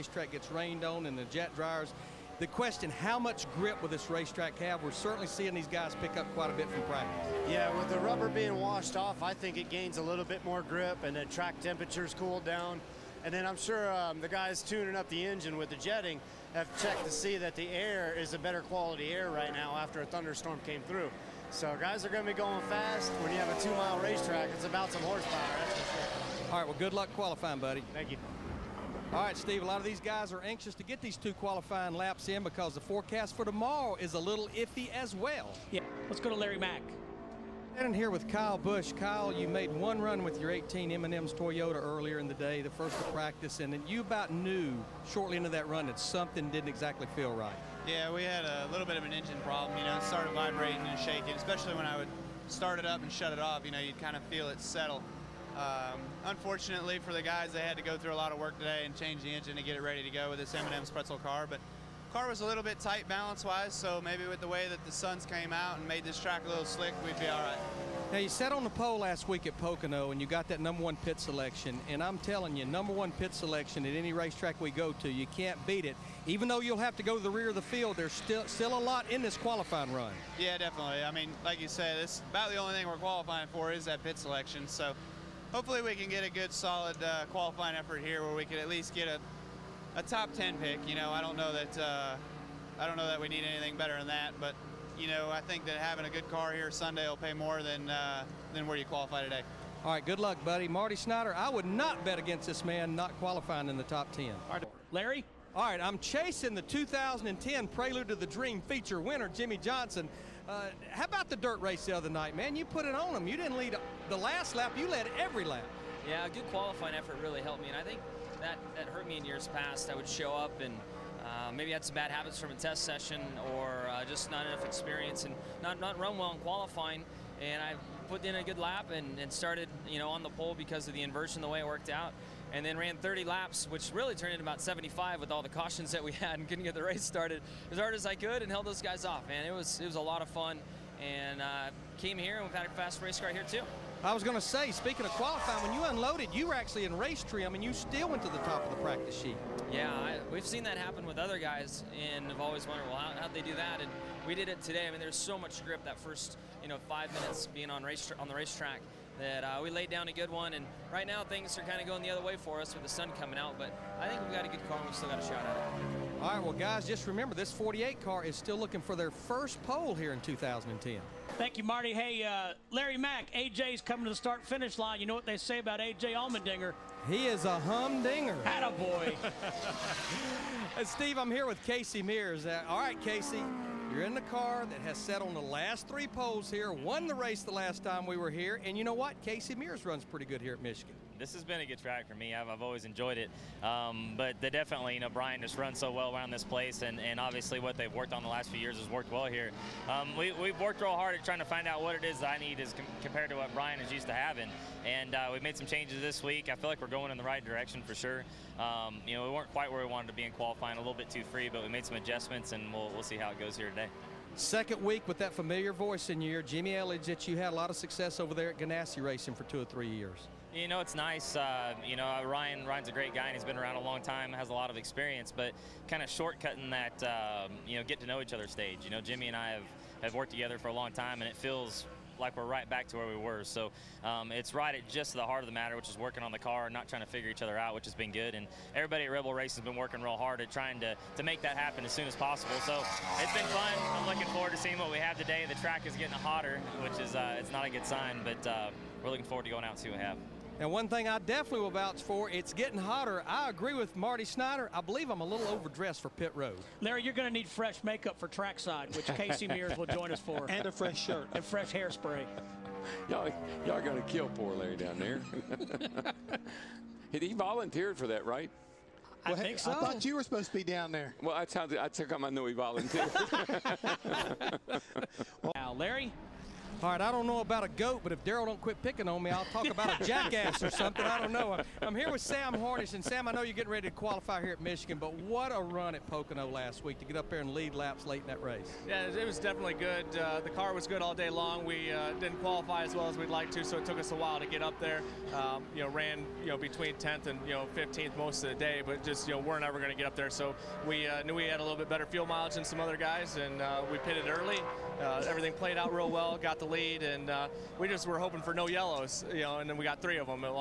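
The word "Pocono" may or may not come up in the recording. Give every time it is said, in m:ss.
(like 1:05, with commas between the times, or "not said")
1:09, 4:46.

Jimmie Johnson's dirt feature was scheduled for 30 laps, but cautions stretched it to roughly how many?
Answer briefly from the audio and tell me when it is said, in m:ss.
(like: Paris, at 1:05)
75, at 2:14.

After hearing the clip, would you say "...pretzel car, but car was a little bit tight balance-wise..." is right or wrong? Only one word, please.
right.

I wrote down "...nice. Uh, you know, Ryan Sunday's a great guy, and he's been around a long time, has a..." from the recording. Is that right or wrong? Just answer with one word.
wrong.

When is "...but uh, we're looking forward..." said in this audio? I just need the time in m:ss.
4:08.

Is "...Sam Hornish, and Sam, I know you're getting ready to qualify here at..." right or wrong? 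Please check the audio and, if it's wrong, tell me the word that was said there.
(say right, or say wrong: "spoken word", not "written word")
right.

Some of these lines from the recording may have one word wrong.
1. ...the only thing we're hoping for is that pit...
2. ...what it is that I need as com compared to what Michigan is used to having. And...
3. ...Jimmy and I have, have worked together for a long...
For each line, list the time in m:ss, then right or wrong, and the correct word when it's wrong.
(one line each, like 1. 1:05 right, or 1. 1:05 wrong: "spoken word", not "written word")
1. 1:22 wrong: "qualifying", not "hoping"
2. 3:21 wrong: "Brian", not "Michigan"
3. 3:49 right.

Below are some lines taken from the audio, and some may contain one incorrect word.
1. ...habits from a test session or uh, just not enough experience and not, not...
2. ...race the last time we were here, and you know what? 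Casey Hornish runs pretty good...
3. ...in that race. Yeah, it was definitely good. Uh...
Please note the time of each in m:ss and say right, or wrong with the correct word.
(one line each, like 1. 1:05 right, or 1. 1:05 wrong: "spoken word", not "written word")
1. 2:02 right
2. 3:07 wrong: "Mears", not "Hornish"
3. 4:48 right.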